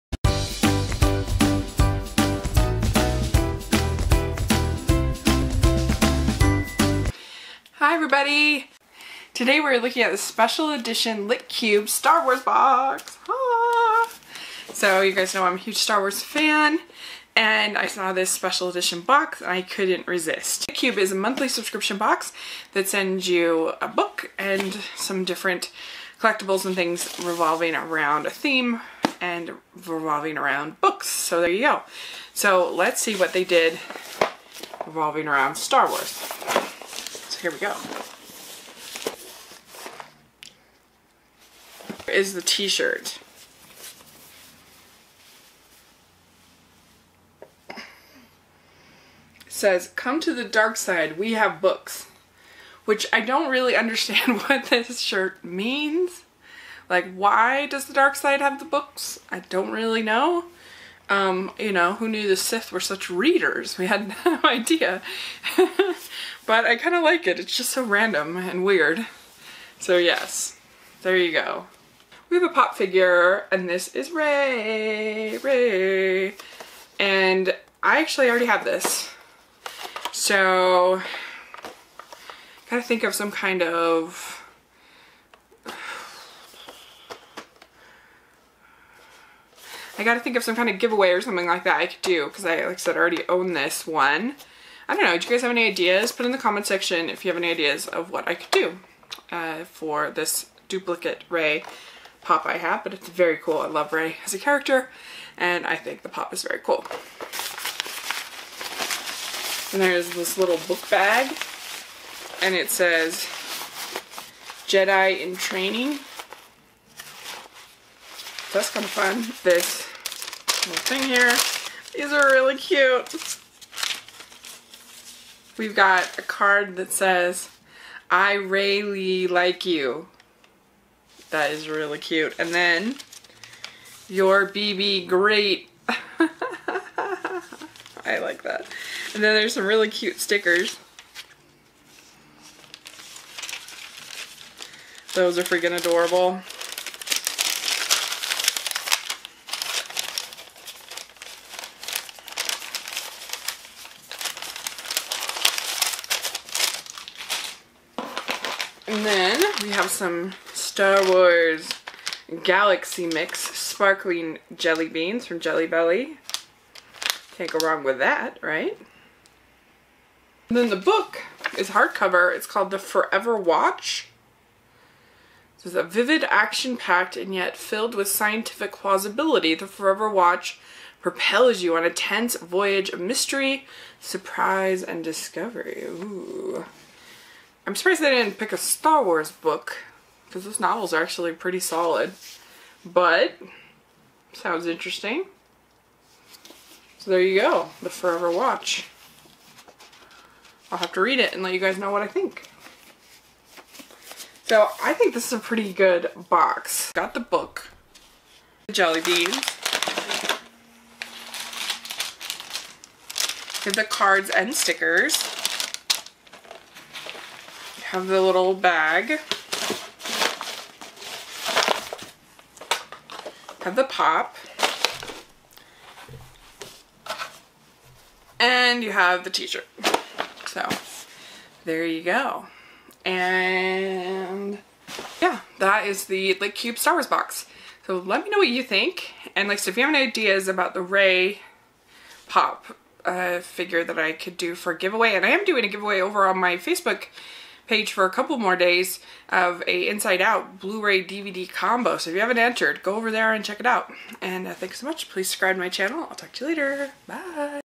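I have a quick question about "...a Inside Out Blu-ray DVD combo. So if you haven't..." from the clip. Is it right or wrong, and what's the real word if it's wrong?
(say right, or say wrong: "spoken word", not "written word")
right.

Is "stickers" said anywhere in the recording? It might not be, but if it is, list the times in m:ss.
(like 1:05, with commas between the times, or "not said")
2:20, 3:34.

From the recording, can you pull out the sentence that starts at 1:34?
I don't know, do you guys have any ideas?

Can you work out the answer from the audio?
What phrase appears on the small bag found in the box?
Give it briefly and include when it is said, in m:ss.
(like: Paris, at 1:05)
Jedi in Training, at 1:54.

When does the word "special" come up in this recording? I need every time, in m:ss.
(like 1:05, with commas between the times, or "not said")
0:10, 0:18.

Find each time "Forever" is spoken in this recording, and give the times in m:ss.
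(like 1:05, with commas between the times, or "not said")
2:52, 2:59, 3:17.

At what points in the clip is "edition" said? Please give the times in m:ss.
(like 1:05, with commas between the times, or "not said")
0:10, 0:18.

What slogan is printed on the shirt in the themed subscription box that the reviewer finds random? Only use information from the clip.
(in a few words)
Come to the dark side, we have books.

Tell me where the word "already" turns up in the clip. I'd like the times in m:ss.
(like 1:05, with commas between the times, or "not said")
1:18, 1:32.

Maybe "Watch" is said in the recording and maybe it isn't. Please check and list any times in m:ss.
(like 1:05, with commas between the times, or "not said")
2:53, 3:00, 3:18.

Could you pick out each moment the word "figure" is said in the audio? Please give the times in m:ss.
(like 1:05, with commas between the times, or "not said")
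1:12, 4:03.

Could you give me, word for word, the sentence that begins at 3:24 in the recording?
So I think this is a pretty good box.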